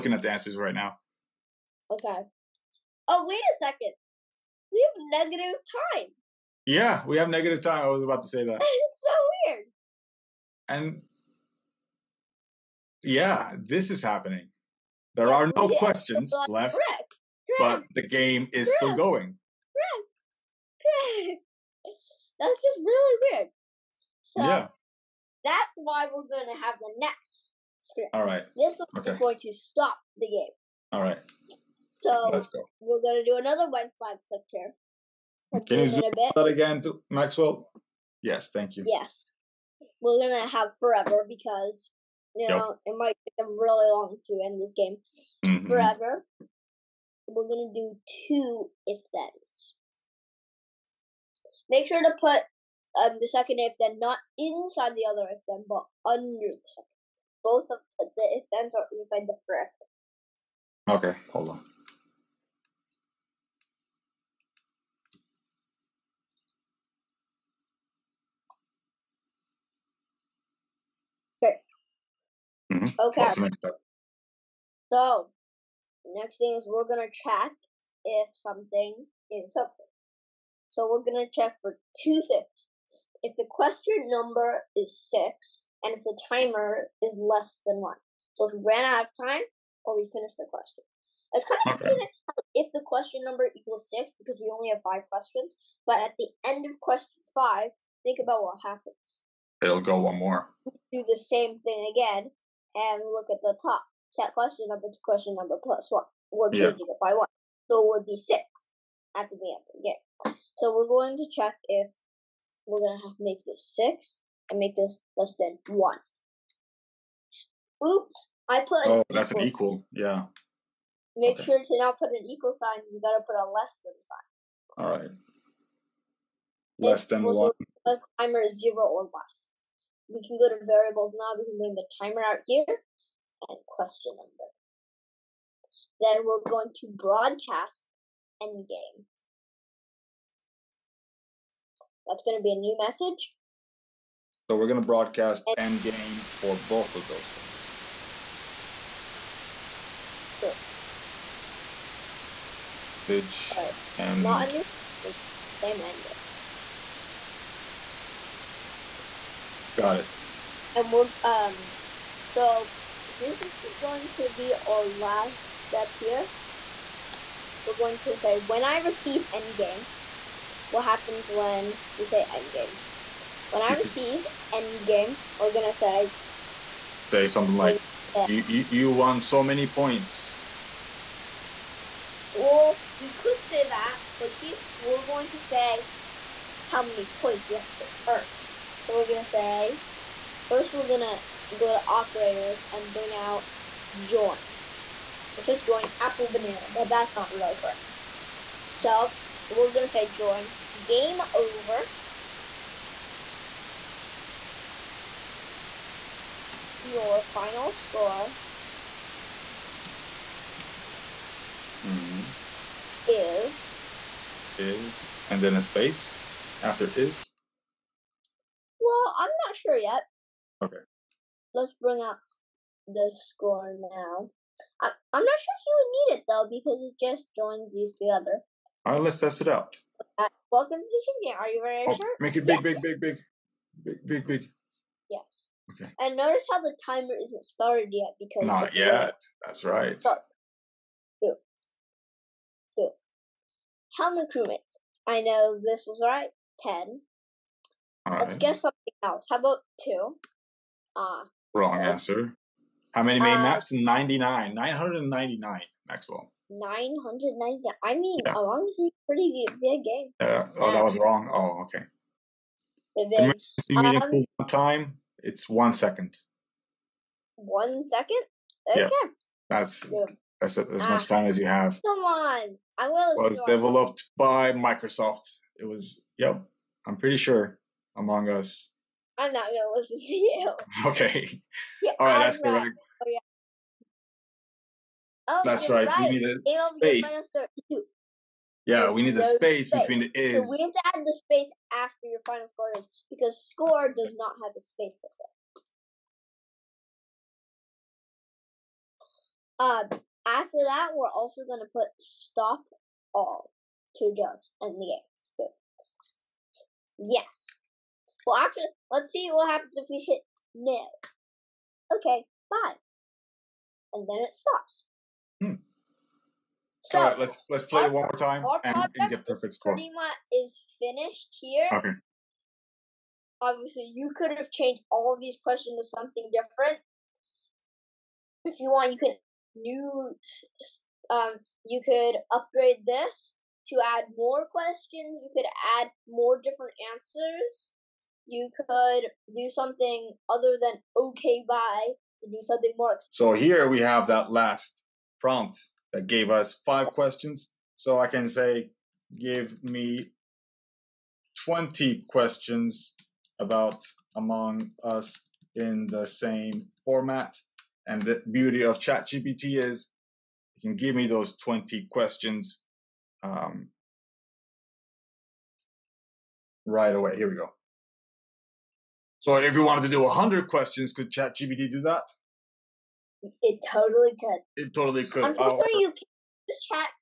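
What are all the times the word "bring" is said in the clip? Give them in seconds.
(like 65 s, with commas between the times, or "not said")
131 s, 192 s, 221 s.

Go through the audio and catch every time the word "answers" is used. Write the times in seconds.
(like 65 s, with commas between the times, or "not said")
0 s, 109 s, 251 s, 336 s.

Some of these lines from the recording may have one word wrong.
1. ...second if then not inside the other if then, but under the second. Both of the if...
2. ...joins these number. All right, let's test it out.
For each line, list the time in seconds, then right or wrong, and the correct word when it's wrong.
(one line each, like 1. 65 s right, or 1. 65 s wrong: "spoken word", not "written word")
1. 53 s right
2. 227 s wrong: "together", not "number".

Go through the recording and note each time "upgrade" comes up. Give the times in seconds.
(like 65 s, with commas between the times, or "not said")
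332 s.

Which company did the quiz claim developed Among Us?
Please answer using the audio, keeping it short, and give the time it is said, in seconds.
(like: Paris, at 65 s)
Microsoft, at 274 s.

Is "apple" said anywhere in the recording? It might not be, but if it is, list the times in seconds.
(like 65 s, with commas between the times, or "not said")
196 s.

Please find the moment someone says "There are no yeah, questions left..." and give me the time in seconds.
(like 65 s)
15 s.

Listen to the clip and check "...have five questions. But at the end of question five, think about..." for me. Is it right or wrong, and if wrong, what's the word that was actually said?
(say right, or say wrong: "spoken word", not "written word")
right.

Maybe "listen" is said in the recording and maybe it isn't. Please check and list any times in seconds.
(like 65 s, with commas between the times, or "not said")
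279 s.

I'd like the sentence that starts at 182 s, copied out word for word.
Well, we could say that, but here we're going to say how many points we actually earned.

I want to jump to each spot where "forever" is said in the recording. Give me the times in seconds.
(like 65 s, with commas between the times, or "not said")
40 s, 45 s, 59 s.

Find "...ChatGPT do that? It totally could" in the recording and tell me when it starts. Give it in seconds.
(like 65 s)
371 s.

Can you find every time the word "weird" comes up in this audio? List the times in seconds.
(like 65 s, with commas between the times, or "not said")
9 s, 23 s.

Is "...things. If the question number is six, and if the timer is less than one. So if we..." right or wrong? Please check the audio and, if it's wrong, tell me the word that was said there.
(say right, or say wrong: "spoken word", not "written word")
right.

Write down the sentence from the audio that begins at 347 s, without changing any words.
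So I can say, give me 20 questions about Among Us in the same format.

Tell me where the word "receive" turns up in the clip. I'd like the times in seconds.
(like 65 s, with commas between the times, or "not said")
168 s, 173 s.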